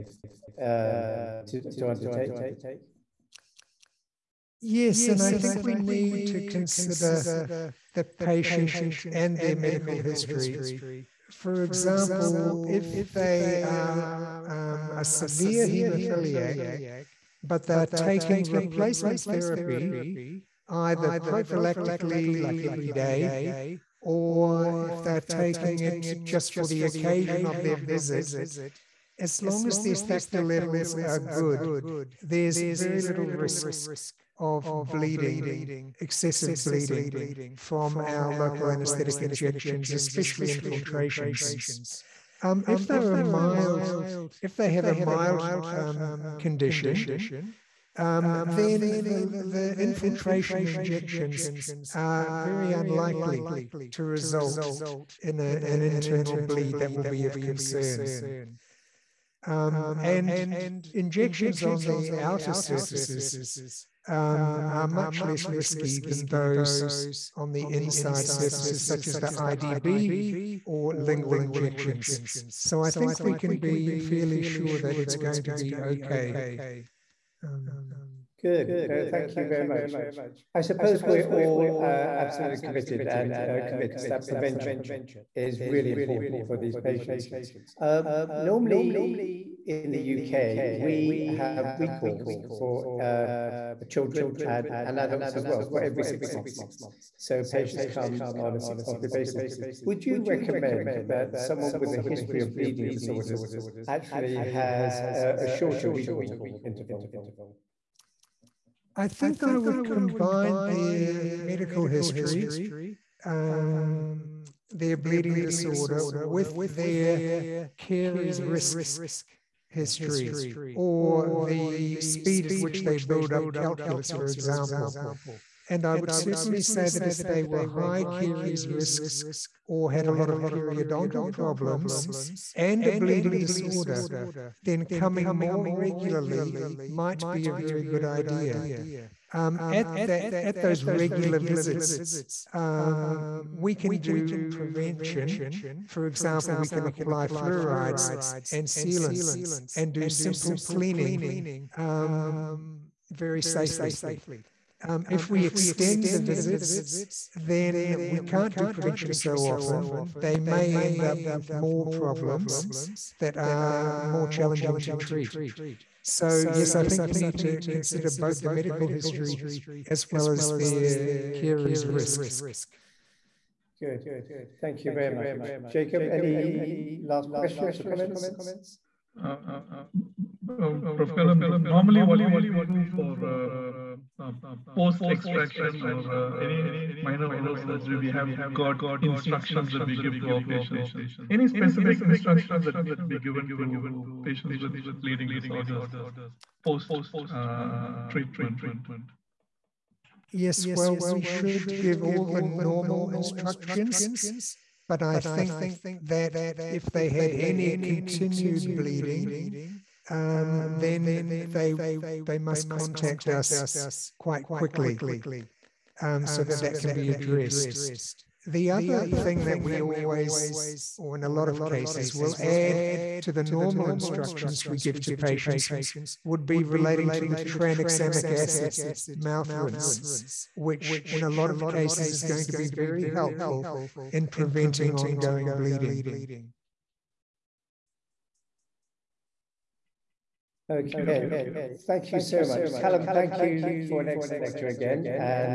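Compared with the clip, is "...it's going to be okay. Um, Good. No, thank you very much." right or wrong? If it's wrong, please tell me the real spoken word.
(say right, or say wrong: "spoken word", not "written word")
right.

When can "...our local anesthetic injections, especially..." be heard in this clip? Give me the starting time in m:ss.
0:38.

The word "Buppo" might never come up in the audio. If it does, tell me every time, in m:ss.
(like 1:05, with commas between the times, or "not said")
not said.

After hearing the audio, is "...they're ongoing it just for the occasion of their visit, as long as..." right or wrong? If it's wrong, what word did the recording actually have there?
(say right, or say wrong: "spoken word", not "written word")
wrong: "taking", not "ongoing".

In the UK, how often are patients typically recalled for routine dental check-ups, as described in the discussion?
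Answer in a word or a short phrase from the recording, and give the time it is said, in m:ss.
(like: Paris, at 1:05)
every 6 months, at 1:35.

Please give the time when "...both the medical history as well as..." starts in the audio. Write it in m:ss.
2:48.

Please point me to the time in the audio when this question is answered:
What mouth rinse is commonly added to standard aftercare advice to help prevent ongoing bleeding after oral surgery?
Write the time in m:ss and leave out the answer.
3:47.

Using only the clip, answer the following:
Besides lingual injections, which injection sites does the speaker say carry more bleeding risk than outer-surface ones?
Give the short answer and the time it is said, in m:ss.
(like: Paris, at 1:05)
IDB, at 1:09.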